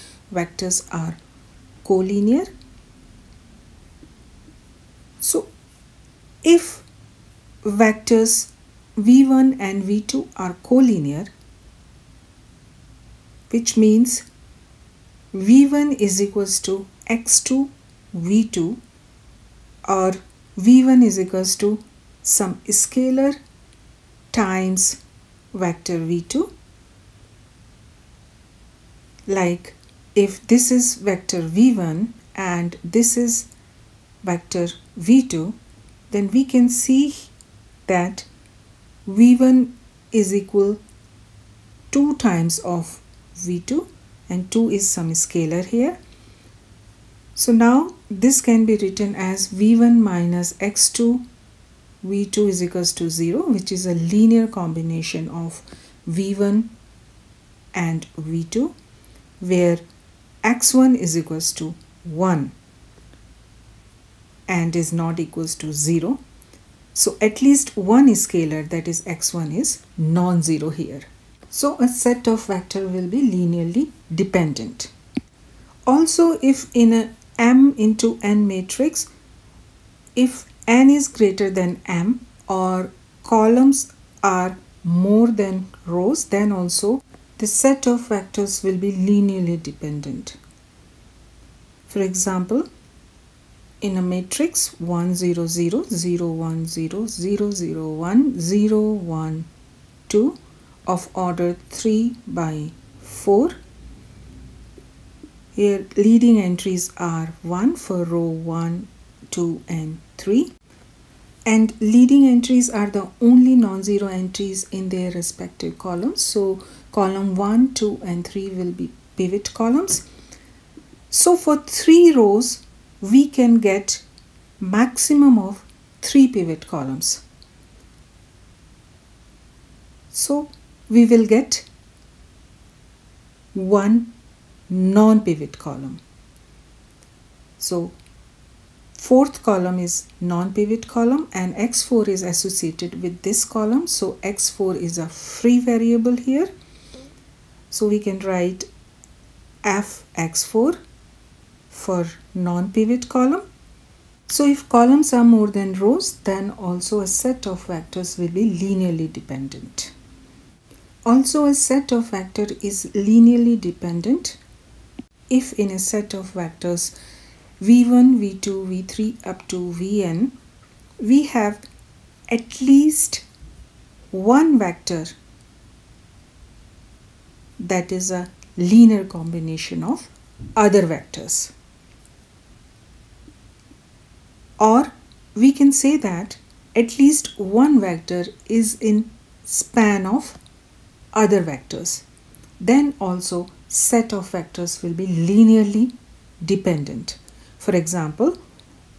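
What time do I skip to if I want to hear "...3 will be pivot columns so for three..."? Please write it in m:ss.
1:58.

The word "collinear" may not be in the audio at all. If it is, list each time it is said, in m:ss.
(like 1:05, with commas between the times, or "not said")
0:01, 0:10.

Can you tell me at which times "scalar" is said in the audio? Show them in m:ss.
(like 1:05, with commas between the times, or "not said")
0:22, 0:45, 1:08.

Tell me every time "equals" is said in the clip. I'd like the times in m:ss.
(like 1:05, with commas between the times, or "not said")
0:16, 0:21, 0:40, 0:52, 1:01, 1:05.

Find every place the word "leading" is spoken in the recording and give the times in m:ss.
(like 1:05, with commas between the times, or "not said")
1:45, 1:51.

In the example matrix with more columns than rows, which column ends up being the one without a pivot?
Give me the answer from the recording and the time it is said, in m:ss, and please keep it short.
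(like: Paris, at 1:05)
Fourth column, at 2:18.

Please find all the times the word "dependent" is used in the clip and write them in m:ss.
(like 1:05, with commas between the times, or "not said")
1:14, 1:29, 2:39, 2:43, 3:16.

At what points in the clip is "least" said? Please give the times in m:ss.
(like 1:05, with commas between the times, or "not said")
1:07, 2:52, 3:06.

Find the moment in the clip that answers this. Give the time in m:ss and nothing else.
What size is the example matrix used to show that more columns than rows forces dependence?
1:41.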